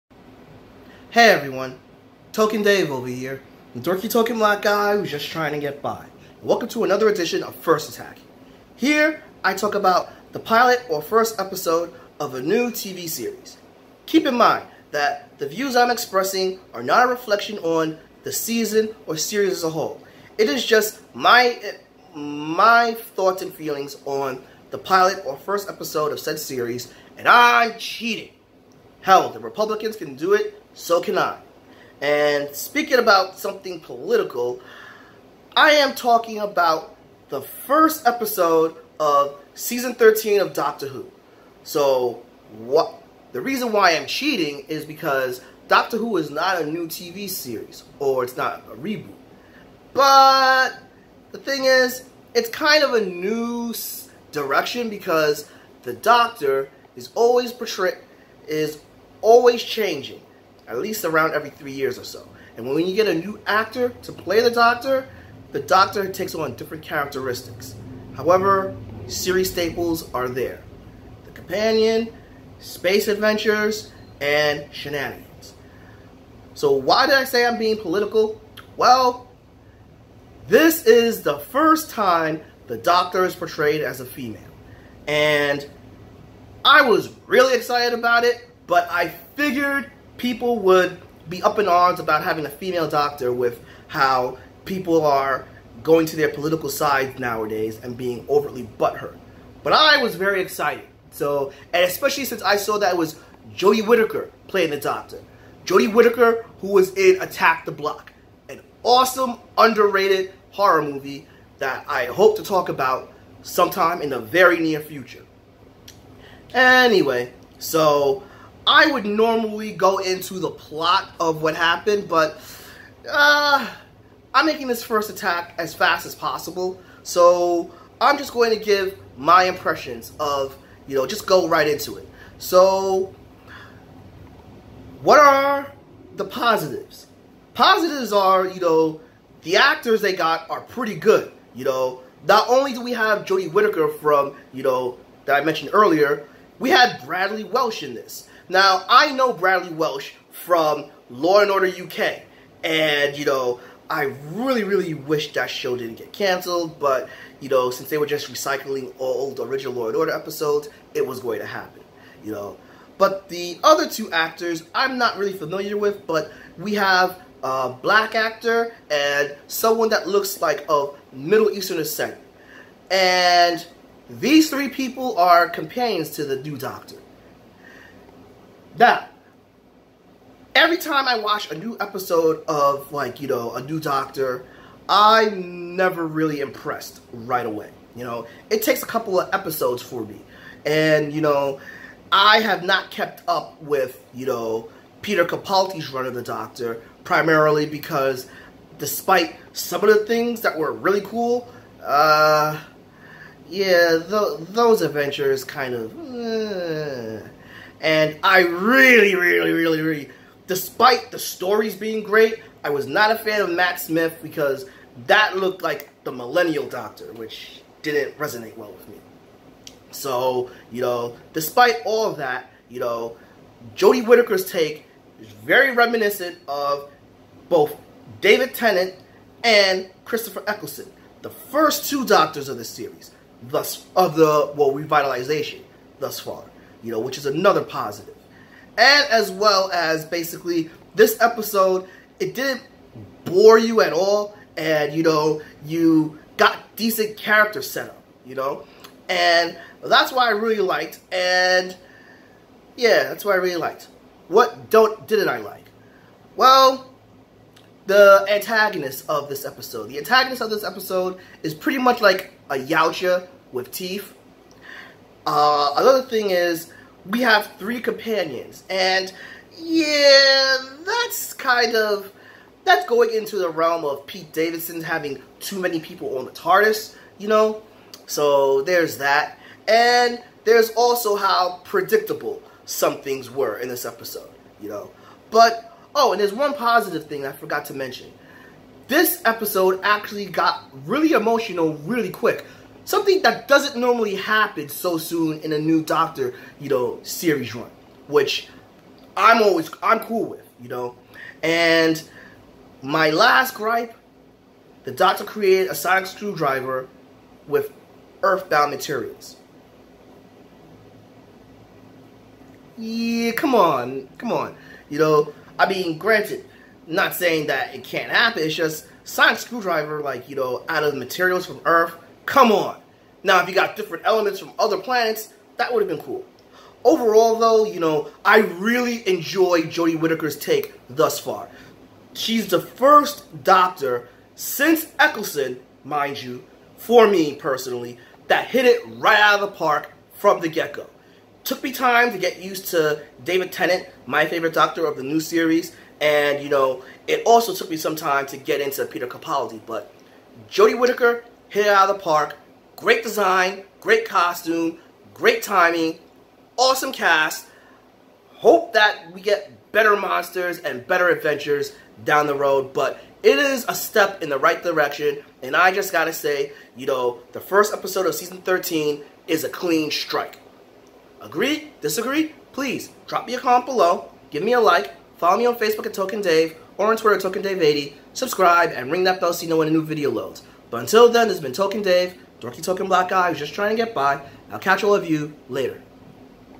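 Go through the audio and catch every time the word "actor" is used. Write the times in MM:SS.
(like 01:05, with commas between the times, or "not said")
01:03, 02:19, 02:44, 02:48.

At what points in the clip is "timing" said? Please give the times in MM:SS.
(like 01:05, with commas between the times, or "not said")
05:55.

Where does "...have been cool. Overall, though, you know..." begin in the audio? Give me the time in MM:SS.
05:25.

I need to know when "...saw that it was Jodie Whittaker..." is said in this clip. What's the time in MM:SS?
01:42.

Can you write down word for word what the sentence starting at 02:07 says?
So I'm just going to give my impressions of, you know, just go right into it.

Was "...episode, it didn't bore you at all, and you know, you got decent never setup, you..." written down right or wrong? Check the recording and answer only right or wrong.
wrong.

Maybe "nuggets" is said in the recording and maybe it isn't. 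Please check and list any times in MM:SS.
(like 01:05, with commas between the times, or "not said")
not said.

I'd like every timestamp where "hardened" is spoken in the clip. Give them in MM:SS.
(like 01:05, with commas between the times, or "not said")
not said.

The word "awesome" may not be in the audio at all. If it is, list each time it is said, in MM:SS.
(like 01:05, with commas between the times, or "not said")
01:48, 05:56.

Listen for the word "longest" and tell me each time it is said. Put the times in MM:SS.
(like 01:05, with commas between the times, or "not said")
not said.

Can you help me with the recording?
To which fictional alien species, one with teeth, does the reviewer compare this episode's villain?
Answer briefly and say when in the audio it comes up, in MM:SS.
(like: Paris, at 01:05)
Yautja, at 04:22.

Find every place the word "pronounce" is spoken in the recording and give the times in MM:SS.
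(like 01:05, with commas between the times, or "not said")
not said.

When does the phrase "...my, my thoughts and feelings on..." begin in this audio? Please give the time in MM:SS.
00:21.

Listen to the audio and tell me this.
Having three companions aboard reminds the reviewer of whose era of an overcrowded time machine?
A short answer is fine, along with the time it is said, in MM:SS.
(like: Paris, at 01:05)
Pete Davison, at 04:34.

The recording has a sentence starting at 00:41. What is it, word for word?
So, what the reason why I'm cheating is because Doctor Who is not a new TV series or it's not a reboot.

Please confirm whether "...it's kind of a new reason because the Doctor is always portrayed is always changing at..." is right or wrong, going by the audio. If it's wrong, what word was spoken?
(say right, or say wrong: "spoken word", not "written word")
wrong: "direction", not "reason".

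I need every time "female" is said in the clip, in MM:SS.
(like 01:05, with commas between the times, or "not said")
01:24, 01:32.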